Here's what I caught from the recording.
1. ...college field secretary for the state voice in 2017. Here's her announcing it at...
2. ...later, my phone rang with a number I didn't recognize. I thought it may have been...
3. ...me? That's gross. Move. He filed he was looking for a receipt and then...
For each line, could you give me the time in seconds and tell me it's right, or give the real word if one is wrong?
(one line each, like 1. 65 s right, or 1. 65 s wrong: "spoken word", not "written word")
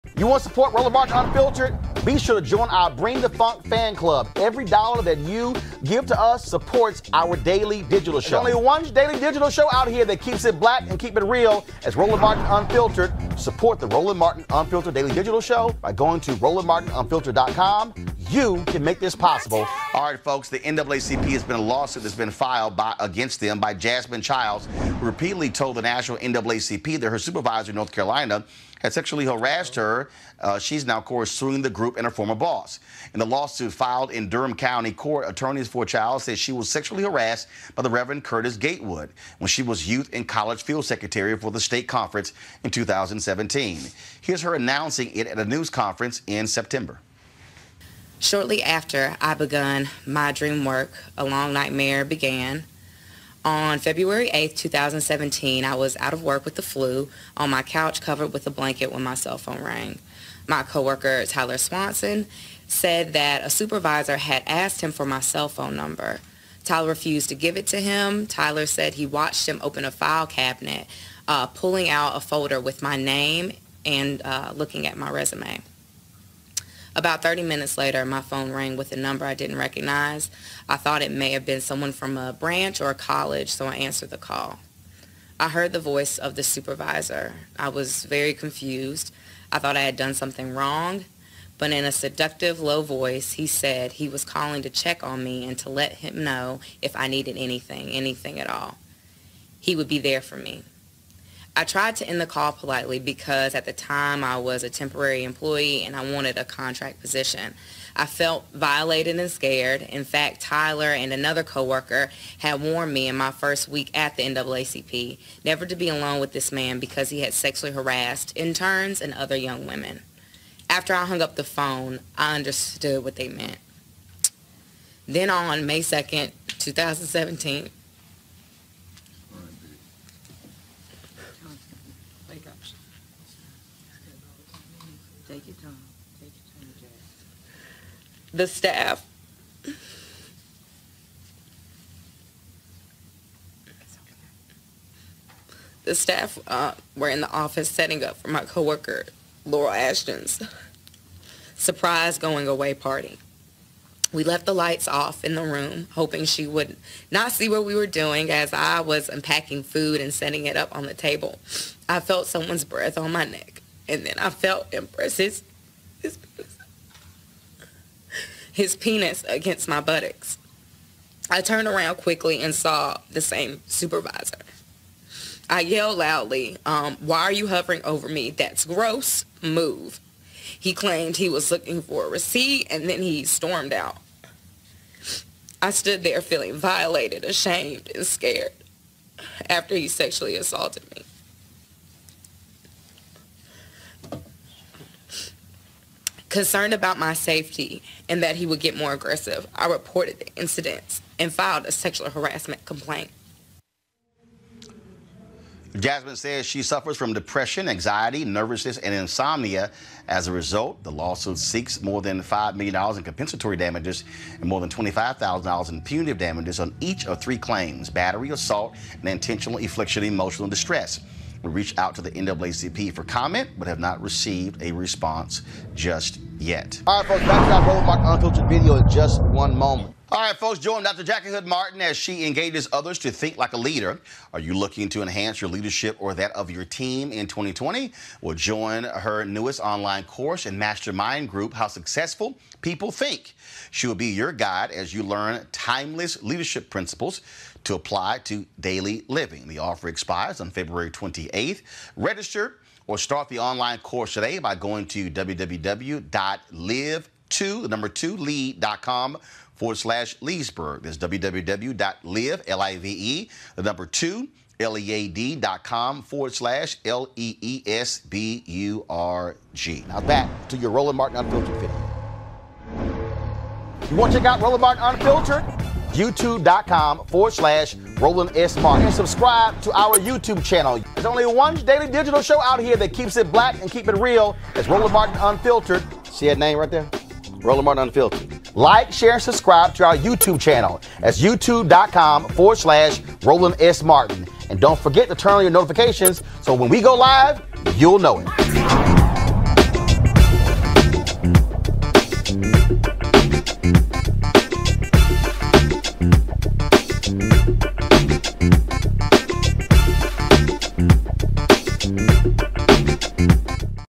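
1. 40 s wrong: "conference", not "voice"
2. 77 s right
3. 178 s wrong: "claimed", not "filed".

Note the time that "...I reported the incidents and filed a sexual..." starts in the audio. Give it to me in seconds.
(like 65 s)
199 s.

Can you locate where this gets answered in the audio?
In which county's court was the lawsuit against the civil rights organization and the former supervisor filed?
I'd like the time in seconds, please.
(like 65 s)
34 s.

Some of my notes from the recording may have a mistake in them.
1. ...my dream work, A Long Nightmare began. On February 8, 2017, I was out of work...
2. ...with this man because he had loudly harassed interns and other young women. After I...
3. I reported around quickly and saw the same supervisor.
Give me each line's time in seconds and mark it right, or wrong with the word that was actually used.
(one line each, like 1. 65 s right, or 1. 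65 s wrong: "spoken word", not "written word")
1. 50 s right
2. 116 s wrong: "sexually", not "loudly"
3. 171 s wrong: "turned", not "reported".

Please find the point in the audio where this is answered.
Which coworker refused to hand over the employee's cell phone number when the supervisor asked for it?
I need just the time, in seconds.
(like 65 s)
61 s.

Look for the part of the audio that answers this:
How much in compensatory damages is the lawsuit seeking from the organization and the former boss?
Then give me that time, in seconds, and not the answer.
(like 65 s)
211 s.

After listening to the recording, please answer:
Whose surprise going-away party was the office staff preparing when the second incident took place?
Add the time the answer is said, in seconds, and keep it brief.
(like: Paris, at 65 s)
Laurel Ashton, at 149 s.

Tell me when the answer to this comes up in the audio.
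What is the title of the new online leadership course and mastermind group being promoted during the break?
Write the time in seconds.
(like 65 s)
241 s.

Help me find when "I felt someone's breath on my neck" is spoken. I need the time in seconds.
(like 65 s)
161 s.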